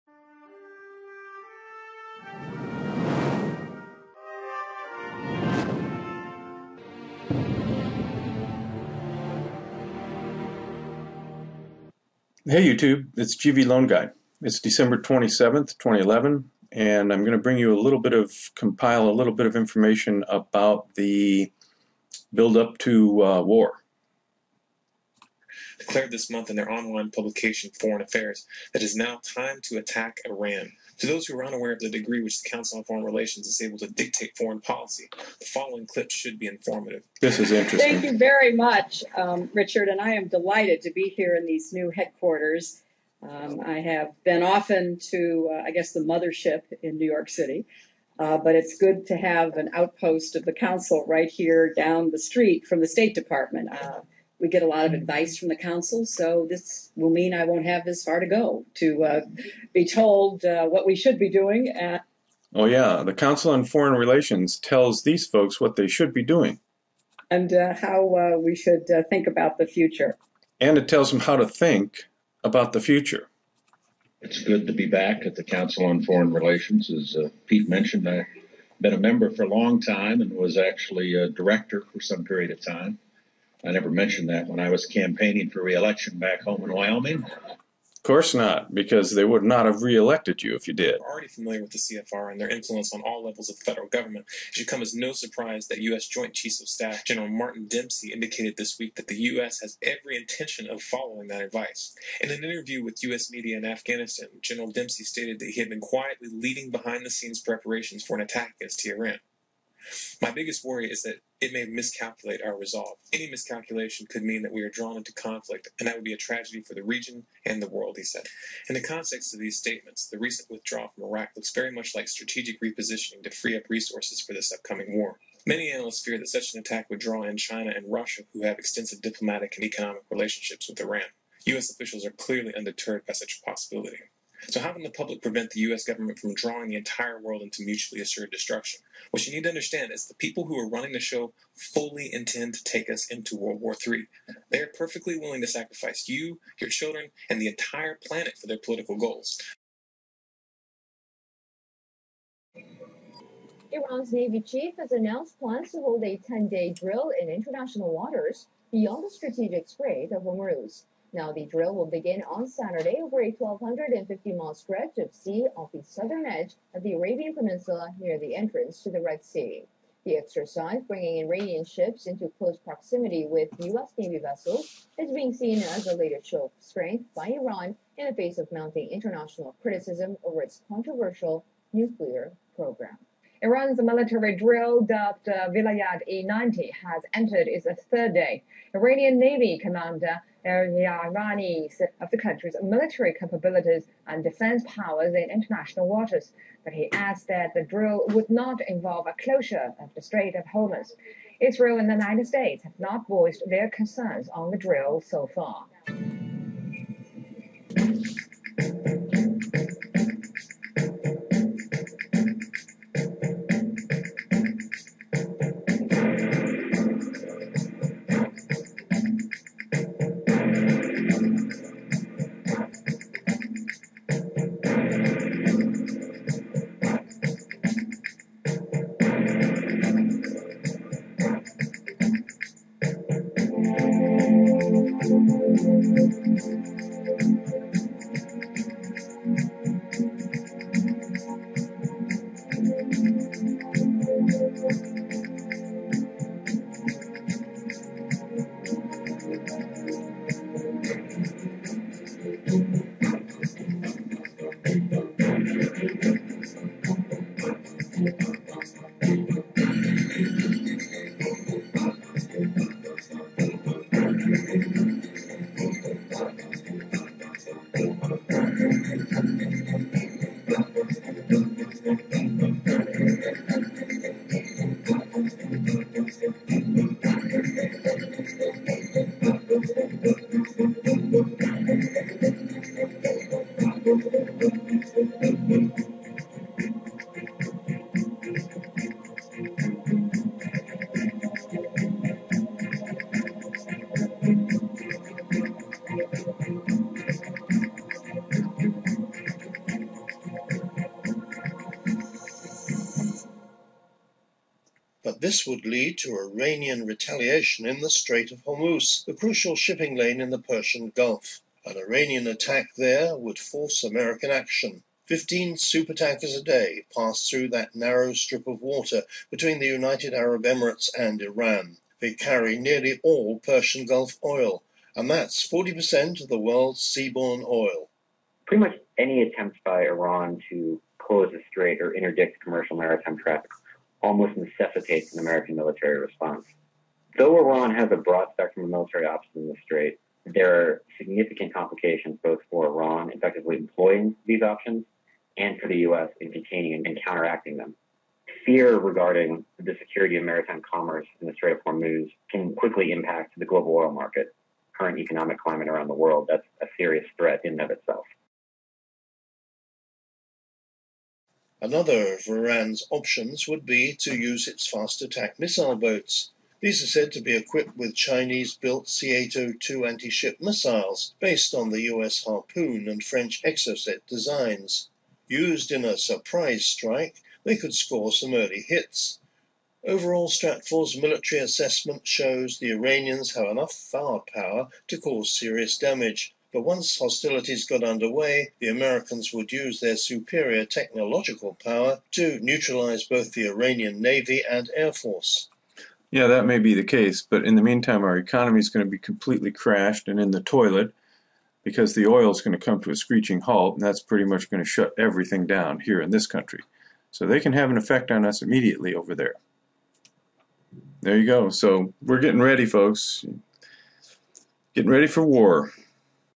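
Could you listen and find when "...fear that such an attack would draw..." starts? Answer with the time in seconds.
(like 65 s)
126 s.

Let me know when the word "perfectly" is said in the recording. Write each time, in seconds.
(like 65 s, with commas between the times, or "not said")
144 s.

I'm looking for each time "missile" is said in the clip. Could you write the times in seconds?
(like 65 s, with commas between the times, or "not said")
365 s, 370 s.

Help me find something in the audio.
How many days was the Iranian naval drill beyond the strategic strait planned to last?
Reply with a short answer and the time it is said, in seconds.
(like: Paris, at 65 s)
10, at 156 s.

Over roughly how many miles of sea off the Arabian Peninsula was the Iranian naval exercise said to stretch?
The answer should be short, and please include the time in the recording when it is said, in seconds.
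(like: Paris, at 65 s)
1,250, at 163 s.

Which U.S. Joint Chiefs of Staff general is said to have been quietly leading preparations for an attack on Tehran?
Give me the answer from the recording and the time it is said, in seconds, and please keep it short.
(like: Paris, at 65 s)
Martin Dempsey, at 97 s.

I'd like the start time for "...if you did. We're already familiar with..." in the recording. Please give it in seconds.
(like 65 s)
90 s.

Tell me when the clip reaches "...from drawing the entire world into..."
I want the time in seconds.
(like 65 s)
136 s.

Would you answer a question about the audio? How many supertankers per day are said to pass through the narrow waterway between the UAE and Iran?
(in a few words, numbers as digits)
15.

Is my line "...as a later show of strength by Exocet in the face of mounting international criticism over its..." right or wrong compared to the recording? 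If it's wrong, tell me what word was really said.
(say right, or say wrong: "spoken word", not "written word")
wrong: "Iran", not "Exocet".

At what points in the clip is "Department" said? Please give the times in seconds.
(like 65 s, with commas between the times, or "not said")
53 s.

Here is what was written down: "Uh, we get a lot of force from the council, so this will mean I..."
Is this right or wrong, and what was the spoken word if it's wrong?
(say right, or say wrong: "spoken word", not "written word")
wrong: "advice", not "force".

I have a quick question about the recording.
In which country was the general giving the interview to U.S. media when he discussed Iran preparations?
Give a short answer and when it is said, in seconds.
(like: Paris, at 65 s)
Afghanistan, at 103 s.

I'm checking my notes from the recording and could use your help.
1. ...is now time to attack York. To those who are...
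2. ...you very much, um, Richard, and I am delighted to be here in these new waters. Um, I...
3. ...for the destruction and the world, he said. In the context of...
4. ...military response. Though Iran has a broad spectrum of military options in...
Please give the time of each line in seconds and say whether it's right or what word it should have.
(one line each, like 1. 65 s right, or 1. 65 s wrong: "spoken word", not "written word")
1. 28 s wrong: "Iran", not "York"
2. 38 s wrong: "headquarters", not "waters"
3. 116 s wrong: "region", not "destruction"
4. 335 s right.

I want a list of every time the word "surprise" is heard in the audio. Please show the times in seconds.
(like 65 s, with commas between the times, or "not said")
95 s, 375 s.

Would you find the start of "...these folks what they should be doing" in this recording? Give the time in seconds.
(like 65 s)
65 s.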